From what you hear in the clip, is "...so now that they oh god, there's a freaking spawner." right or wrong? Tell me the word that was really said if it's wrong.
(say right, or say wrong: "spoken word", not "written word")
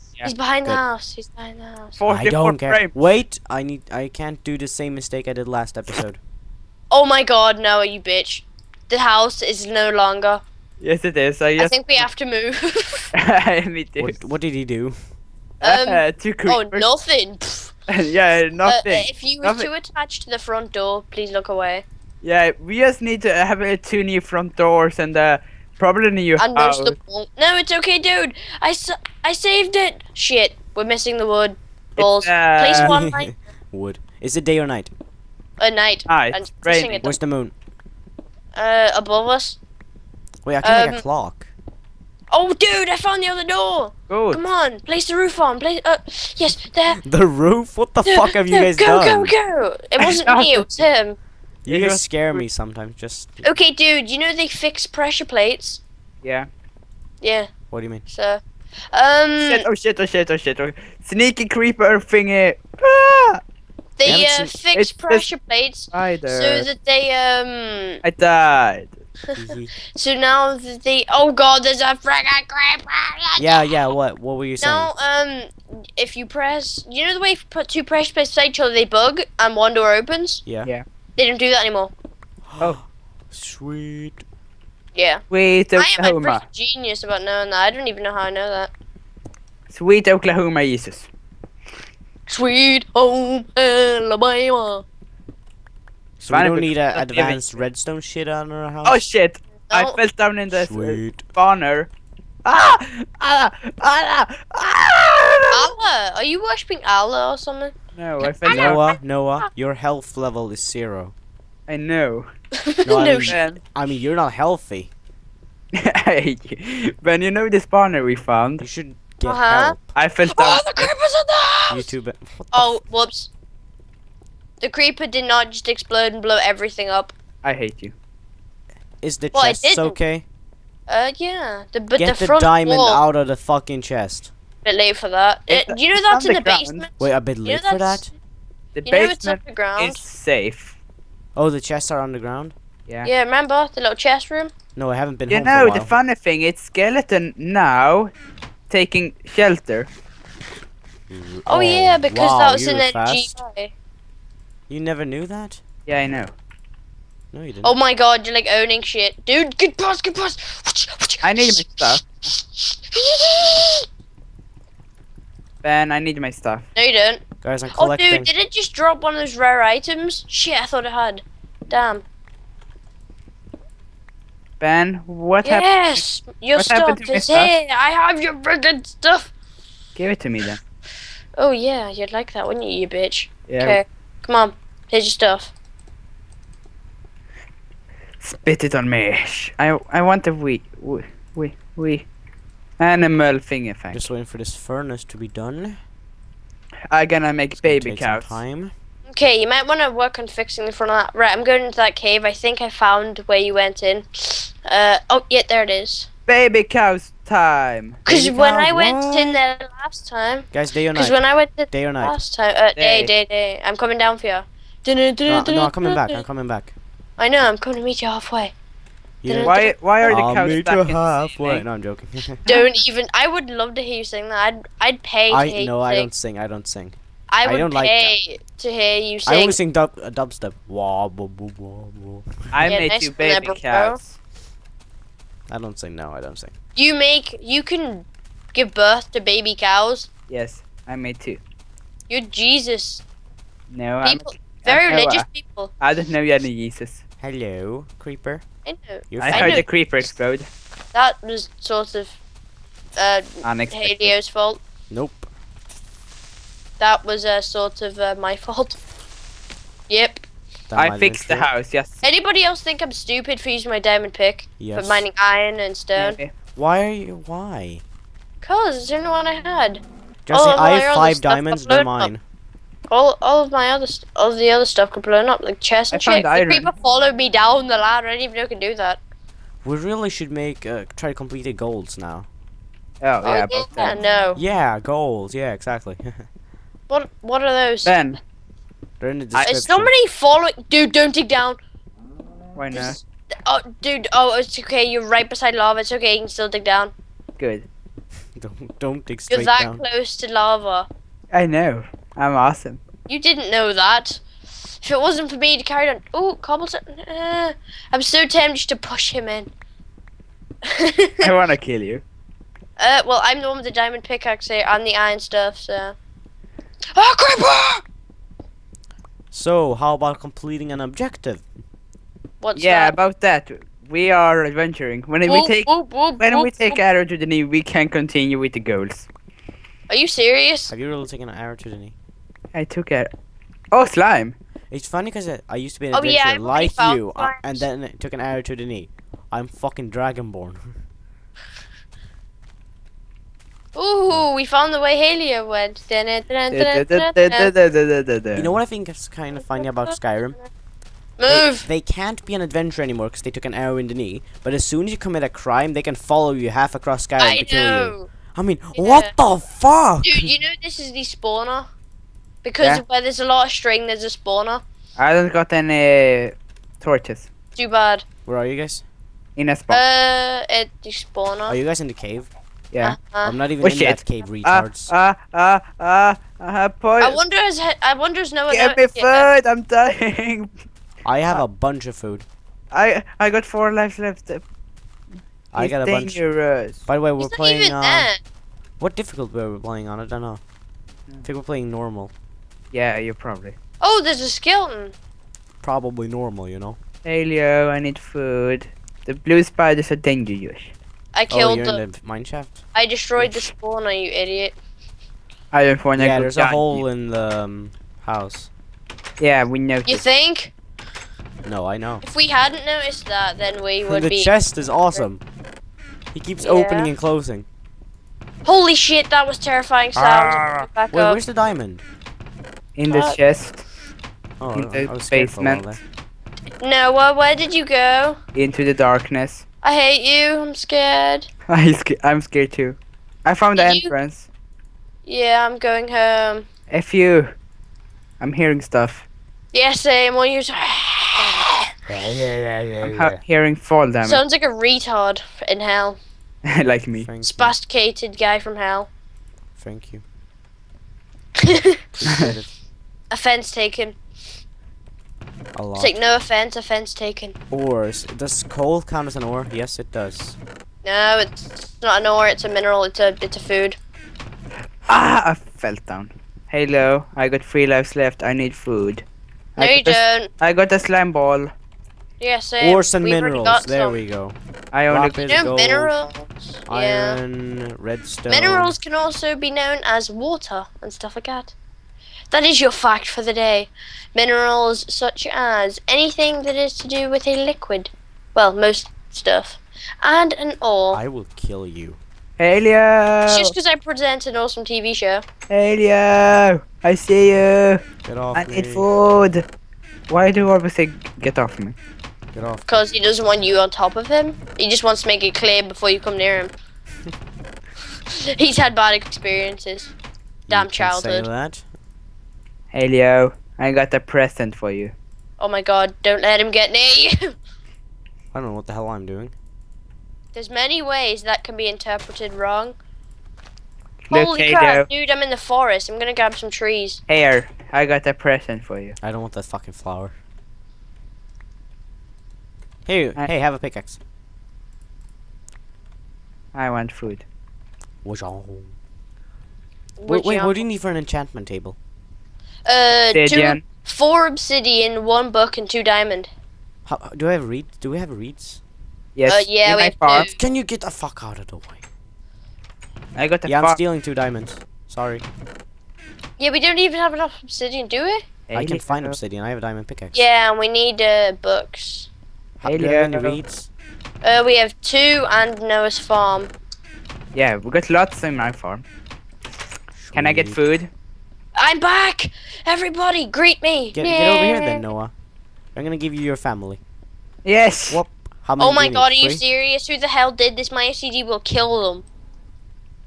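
wrong: "creeper", not "spawner".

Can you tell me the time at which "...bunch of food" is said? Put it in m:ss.
6:21.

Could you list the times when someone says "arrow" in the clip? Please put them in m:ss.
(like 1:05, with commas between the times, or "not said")
5:26, 5:31, 5:38, 5:53.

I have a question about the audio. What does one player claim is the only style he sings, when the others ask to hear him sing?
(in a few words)
Dubstep.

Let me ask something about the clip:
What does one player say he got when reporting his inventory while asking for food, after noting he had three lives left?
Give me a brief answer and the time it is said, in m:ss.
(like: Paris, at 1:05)
A slime ball, at 7:50.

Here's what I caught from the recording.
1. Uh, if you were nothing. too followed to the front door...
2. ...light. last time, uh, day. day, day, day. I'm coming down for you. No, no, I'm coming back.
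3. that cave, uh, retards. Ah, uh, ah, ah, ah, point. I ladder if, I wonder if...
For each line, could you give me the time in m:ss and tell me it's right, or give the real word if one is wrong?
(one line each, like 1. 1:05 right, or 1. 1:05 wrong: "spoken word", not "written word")
1. 0:18 wrong: "attached", not "followed"
2. 3:31 wrong: "night", not "light"
3. 6:13 wrong: "wonder", not "ladder".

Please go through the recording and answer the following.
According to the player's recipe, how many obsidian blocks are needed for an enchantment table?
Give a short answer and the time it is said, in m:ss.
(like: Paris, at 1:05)
4, at 9:03.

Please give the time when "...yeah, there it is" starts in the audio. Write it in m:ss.
3:25.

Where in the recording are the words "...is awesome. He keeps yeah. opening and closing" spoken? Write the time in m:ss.
6:54.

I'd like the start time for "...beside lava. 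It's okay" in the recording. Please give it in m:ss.
4:55.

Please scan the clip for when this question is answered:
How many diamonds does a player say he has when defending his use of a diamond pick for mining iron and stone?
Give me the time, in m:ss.
4:30.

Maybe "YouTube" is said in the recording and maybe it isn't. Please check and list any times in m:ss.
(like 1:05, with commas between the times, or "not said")
2:01.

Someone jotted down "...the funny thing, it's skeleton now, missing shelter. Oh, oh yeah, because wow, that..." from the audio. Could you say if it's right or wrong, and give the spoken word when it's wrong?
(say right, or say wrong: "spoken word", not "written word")
wrong: "taking", not "missing".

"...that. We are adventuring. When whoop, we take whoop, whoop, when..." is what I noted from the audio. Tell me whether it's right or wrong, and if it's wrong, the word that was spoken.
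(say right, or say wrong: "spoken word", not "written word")
right.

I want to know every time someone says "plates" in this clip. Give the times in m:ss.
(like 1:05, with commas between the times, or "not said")
0:55, 1:05, 1:18.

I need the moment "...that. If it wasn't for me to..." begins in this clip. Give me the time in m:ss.
5:03.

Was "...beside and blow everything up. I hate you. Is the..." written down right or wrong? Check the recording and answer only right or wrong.
wrong.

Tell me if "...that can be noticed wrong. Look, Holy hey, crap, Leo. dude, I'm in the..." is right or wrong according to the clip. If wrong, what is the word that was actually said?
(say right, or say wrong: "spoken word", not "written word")
wrong: "interpreted", not "noticed".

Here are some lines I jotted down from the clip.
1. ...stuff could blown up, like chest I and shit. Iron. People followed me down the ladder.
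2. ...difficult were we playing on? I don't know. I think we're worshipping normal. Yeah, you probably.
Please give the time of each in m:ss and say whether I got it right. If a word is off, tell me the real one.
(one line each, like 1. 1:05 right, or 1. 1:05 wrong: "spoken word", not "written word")
1. 4:34 right
2. 6:28 wrong: "playing", not "worshipping".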